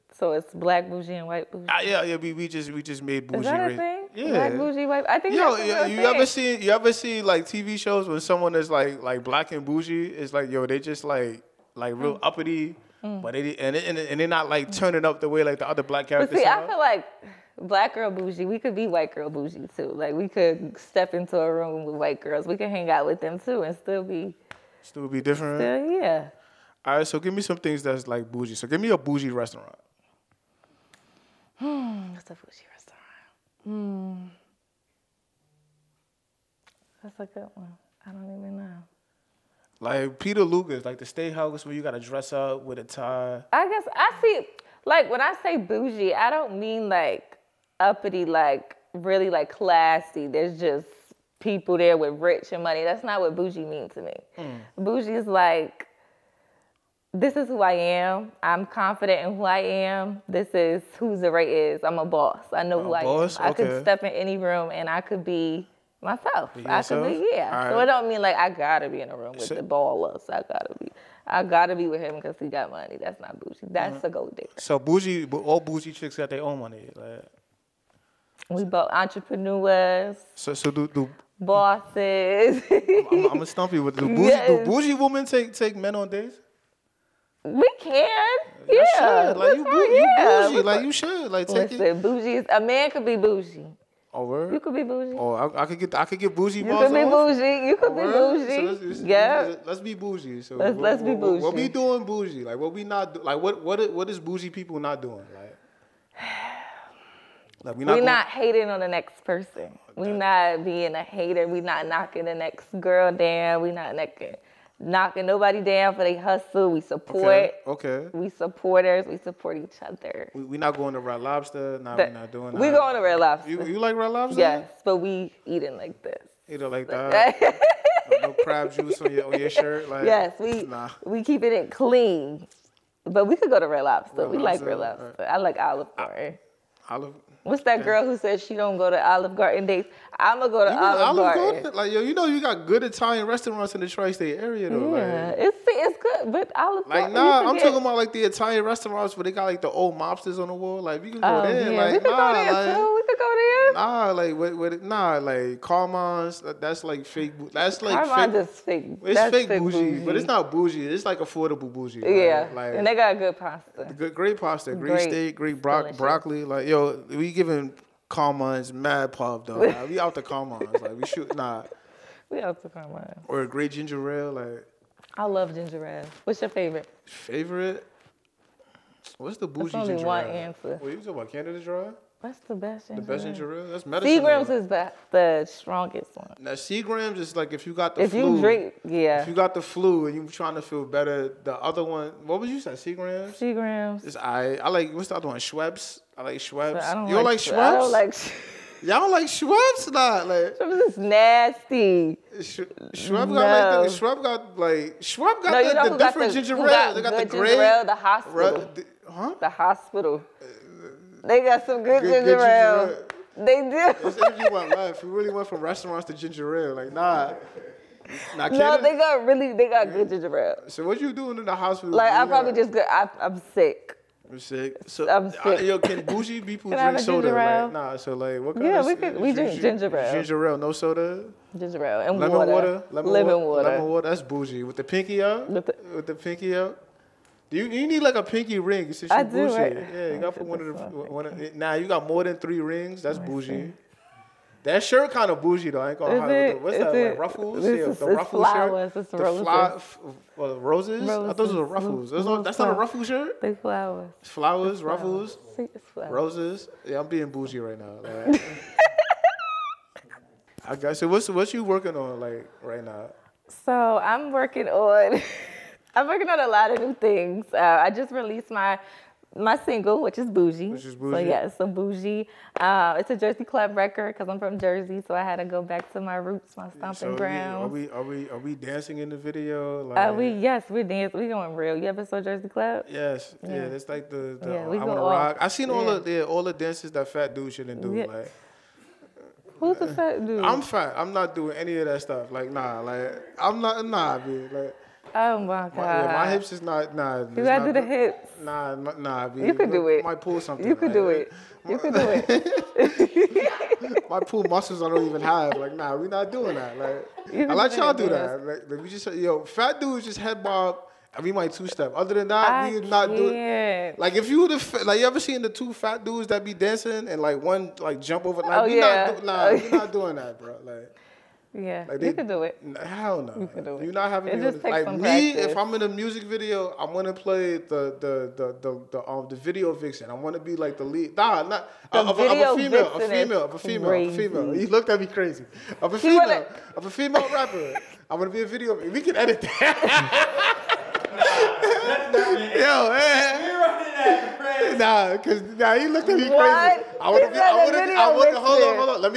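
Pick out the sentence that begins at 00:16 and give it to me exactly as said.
But see, I feel like black girl bougie.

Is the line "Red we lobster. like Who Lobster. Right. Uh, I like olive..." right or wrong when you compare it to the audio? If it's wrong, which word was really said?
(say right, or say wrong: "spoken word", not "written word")
wrong: "Red", not "Who".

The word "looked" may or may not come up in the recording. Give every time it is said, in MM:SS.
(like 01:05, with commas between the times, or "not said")
05:34, 05:45.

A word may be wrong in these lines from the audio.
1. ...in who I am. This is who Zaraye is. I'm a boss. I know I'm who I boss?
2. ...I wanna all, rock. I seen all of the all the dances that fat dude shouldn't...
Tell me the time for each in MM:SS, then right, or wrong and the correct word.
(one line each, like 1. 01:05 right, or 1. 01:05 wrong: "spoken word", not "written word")
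1. 00:59 right
2. 04:44 right.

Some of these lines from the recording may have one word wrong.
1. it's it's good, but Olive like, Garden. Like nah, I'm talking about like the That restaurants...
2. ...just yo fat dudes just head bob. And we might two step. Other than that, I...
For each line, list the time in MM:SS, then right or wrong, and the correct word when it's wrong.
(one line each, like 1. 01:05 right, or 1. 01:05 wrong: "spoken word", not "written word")
1. 02:25 wrong: "Italian", not "That"
2. 05:08 right.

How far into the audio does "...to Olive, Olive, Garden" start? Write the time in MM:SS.
02:20.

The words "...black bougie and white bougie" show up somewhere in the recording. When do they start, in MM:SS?
00:00.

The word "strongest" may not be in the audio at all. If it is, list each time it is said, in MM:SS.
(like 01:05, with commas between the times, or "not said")
03:05.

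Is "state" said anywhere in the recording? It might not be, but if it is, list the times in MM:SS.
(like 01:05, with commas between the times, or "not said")
00:41, 02:23.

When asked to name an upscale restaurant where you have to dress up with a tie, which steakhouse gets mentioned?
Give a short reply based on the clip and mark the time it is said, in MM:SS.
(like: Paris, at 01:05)
Peter Luger, at 00:40.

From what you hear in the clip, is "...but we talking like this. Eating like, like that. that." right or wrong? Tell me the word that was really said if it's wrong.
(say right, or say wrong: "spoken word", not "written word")
wrong: "eating", not "talking".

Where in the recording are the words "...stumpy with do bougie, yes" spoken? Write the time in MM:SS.
01:23.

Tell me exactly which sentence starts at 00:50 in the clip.
There's just people there with rich and money.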